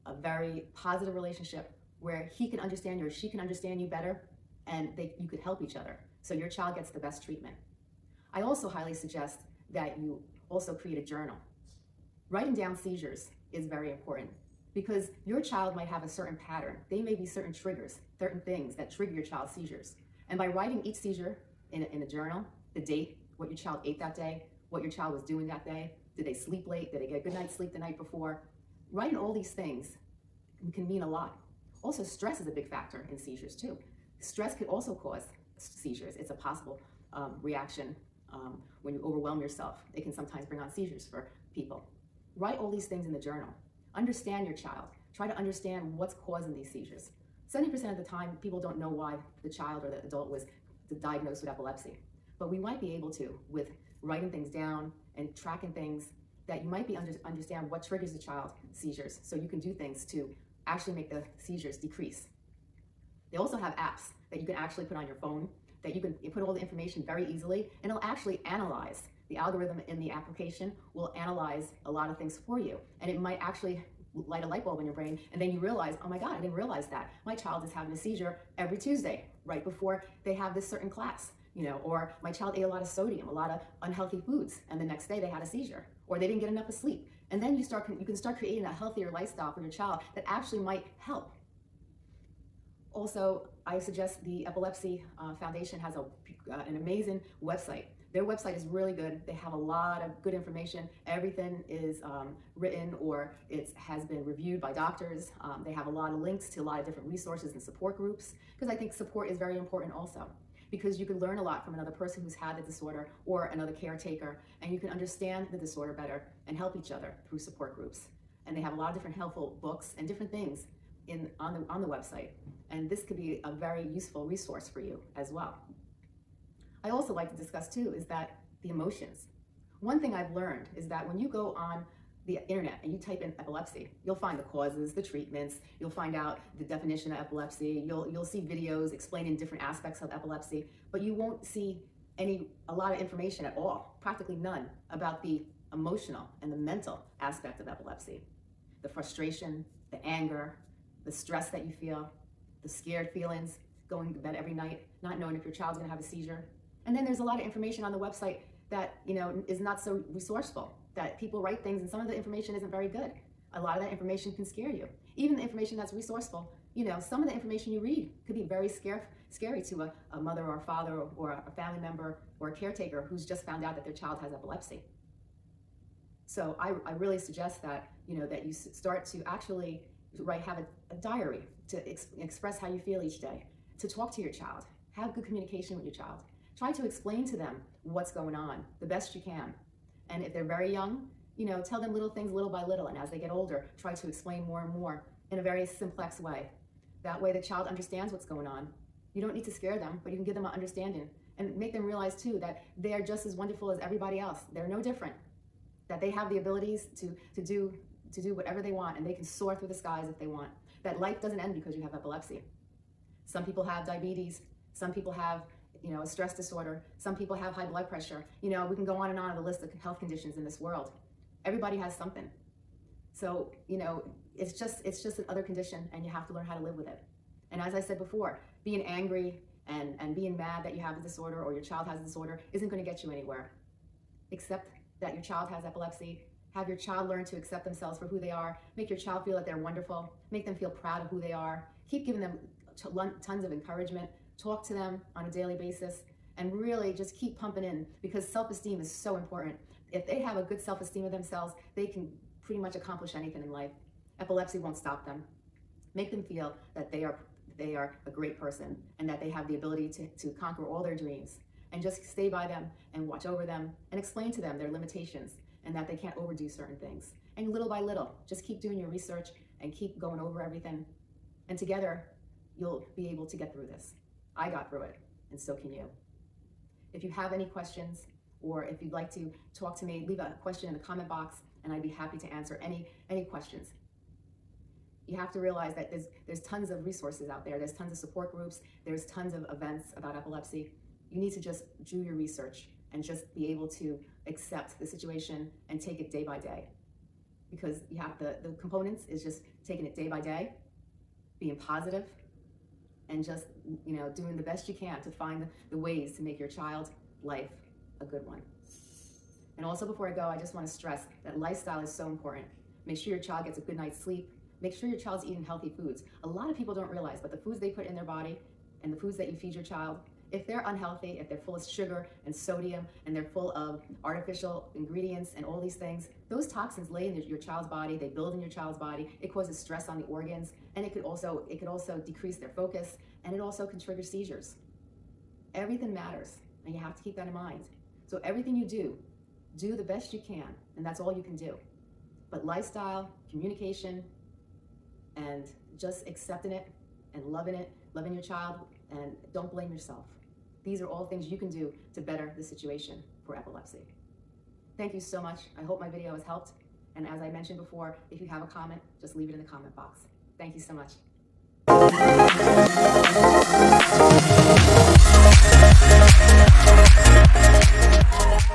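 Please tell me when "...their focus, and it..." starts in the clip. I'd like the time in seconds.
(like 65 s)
332 s.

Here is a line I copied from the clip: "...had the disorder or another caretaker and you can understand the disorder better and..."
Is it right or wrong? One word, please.
right.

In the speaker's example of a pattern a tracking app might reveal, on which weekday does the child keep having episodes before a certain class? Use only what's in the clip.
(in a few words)
Tuesday.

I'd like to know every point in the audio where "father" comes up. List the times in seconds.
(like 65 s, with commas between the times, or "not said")
170 s.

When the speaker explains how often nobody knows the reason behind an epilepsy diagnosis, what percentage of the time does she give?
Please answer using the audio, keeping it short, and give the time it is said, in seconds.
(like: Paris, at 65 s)
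70%, at 47 s.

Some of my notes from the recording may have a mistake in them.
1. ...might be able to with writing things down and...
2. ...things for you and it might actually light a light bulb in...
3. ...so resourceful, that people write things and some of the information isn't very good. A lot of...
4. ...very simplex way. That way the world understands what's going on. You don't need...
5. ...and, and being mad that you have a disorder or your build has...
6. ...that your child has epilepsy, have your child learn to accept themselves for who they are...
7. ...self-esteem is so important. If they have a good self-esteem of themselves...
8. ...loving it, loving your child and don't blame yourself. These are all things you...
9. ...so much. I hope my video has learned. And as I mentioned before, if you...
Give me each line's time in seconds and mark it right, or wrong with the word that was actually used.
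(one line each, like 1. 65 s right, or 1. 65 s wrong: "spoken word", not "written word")
1. 52 s right
2. 72 s right
3. 159 s right
4. 195 s wrong: "child", not "world"
5. 229 s wrong: "child", not "build"
6. 234 s right
7. 248 s right
8. 347 s right
9. 354 s wrong: "helped", not "learned".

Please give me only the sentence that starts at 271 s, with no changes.
And together, you'll be able to get through this.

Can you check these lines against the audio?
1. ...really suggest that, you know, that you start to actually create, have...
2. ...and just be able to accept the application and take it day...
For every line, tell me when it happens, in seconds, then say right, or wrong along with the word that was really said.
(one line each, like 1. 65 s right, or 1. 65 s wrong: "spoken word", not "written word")
1. 176 s wrong: "write", not "create"
2. 292 s wrong: "situation", not "application".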